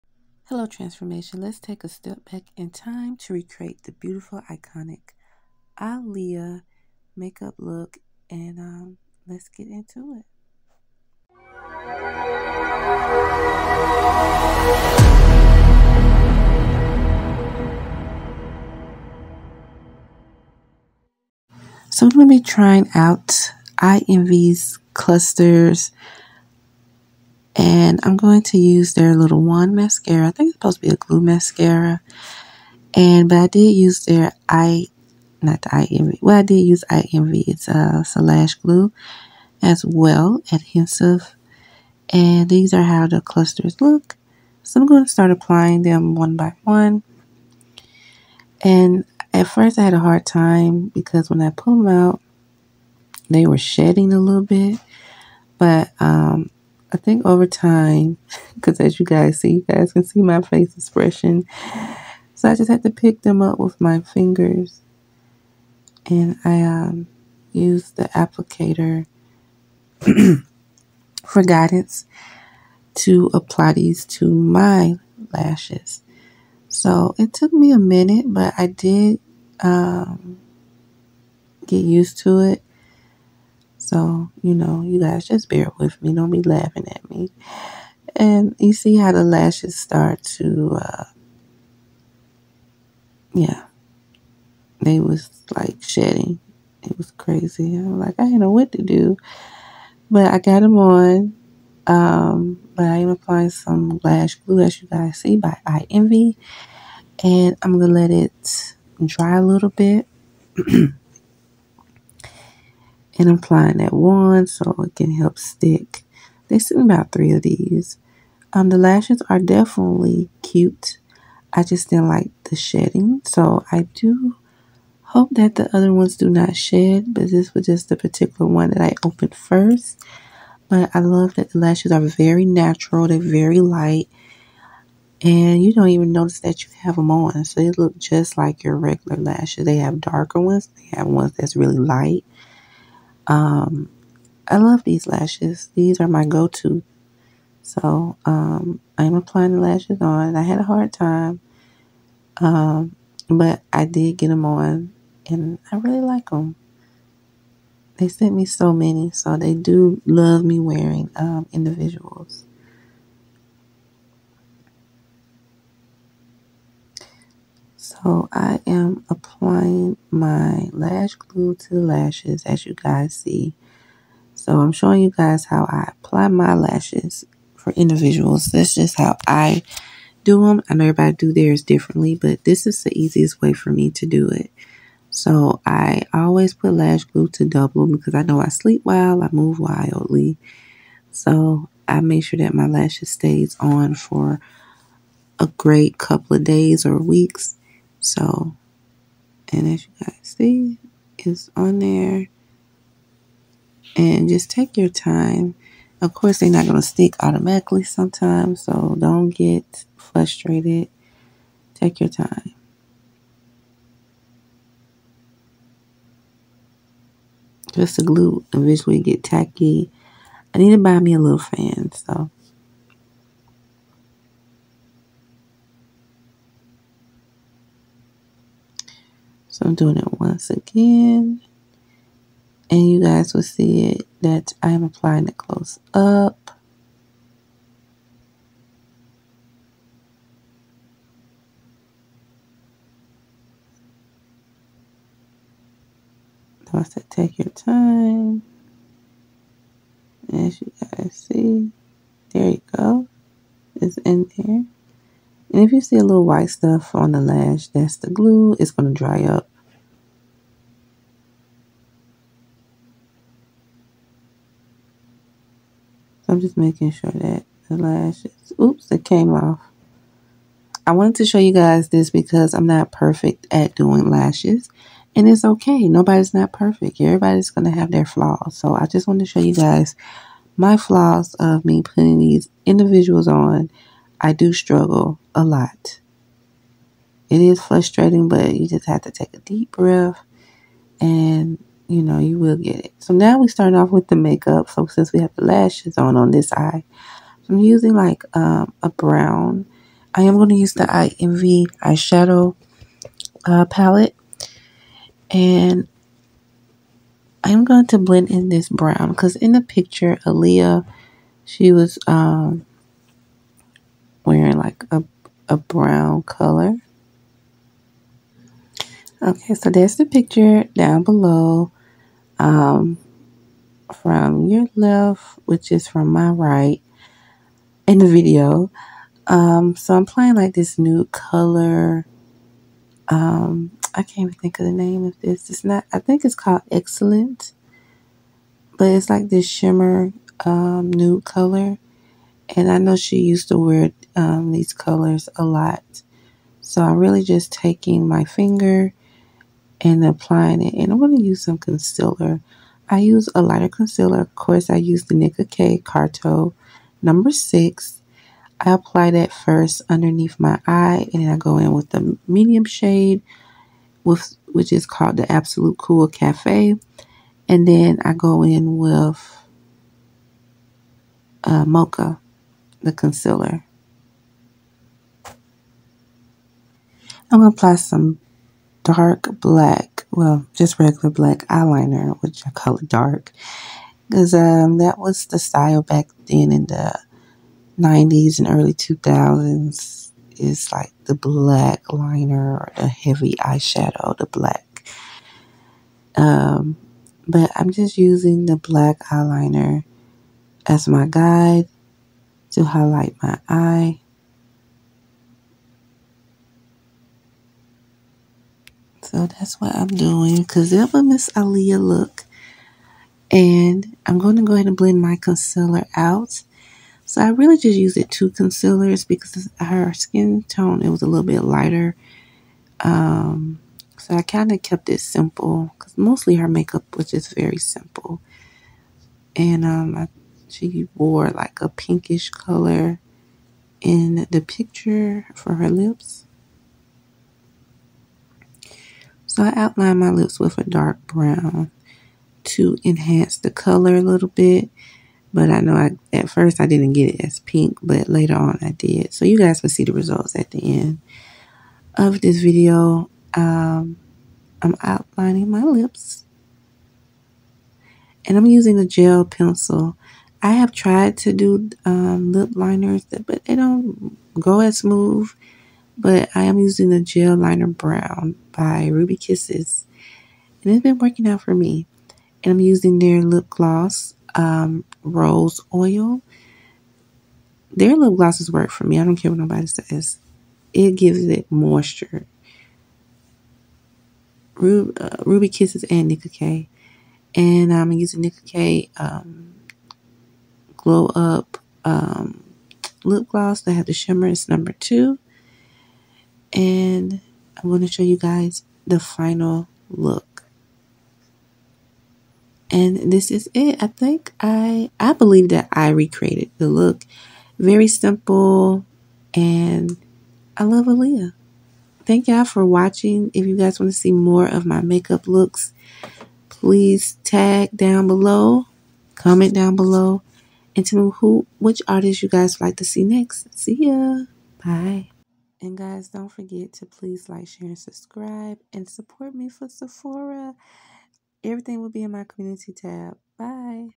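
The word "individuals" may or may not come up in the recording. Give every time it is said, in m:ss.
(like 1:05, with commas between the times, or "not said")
2:41, 2:57, 4:42.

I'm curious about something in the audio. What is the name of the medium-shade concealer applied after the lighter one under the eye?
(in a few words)
Absolute Cool Cafe.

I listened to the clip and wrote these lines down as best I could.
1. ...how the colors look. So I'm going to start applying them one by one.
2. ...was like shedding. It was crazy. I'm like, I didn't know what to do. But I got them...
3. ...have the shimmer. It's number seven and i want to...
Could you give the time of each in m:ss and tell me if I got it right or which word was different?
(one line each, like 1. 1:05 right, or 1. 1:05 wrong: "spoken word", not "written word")
1. 0:42 wrong: "clusters", not "colors"
2. 1:35 right
3. 8:13 wrong: "two", not "seven".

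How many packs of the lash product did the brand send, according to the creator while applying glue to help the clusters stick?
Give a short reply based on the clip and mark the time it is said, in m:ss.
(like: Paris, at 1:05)
3, at 1:56.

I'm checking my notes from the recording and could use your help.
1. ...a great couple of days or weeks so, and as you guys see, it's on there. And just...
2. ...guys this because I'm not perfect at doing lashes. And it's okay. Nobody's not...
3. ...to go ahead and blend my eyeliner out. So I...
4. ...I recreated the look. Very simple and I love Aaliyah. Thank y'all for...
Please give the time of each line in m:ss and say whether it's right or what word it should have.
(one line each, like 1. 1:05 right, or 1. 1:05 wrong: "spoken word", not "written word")
1. 3:15 right
2. 4:31 right
3. 6:54 wrong: "concealer", not "eyeliner"
4. 8:25 right.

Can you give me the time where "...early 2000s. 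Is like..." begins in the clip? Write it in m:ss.
6:28.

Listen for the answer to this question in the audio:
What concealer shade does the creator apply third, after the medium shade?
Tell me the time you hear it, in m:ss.
6:11.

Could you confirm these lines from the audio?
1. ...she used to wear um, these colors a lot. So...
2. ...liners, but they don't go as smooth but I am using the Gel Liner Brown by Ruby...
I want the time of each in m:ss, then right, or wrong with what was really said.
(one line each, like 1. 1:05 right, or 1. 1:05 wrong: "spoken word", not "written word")
1. 5:42 right
2. 7:42 right.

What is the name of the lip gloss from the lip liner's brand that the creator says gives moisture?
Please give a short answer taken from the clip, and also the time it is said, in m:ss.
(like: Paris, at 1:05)
Rose Oil, at 7:55.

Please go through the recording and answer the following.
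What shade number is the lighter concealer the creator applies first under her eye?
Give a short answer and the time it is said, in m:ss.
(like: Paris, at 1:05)
6, at 5:57.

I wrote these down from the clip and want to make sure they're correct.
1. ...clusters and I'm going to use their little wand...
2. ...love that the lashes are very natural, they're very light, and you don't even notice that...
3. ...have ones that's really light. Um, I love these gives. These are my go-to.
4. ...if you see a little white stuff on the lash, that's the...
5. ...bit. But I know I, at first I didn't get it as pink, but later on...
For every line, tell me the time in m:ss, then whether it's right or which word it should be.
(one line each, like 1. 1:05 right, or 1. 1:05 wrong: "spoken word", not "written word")
1. 0:24 right
2. 2:10 right
3. 2:20 wrong: "lashes", not "gives"
4. 4:15 right
5. 7:24 right.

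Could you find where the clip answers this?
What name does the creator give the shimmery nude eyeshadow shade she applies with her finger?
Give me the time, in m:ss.
5:35.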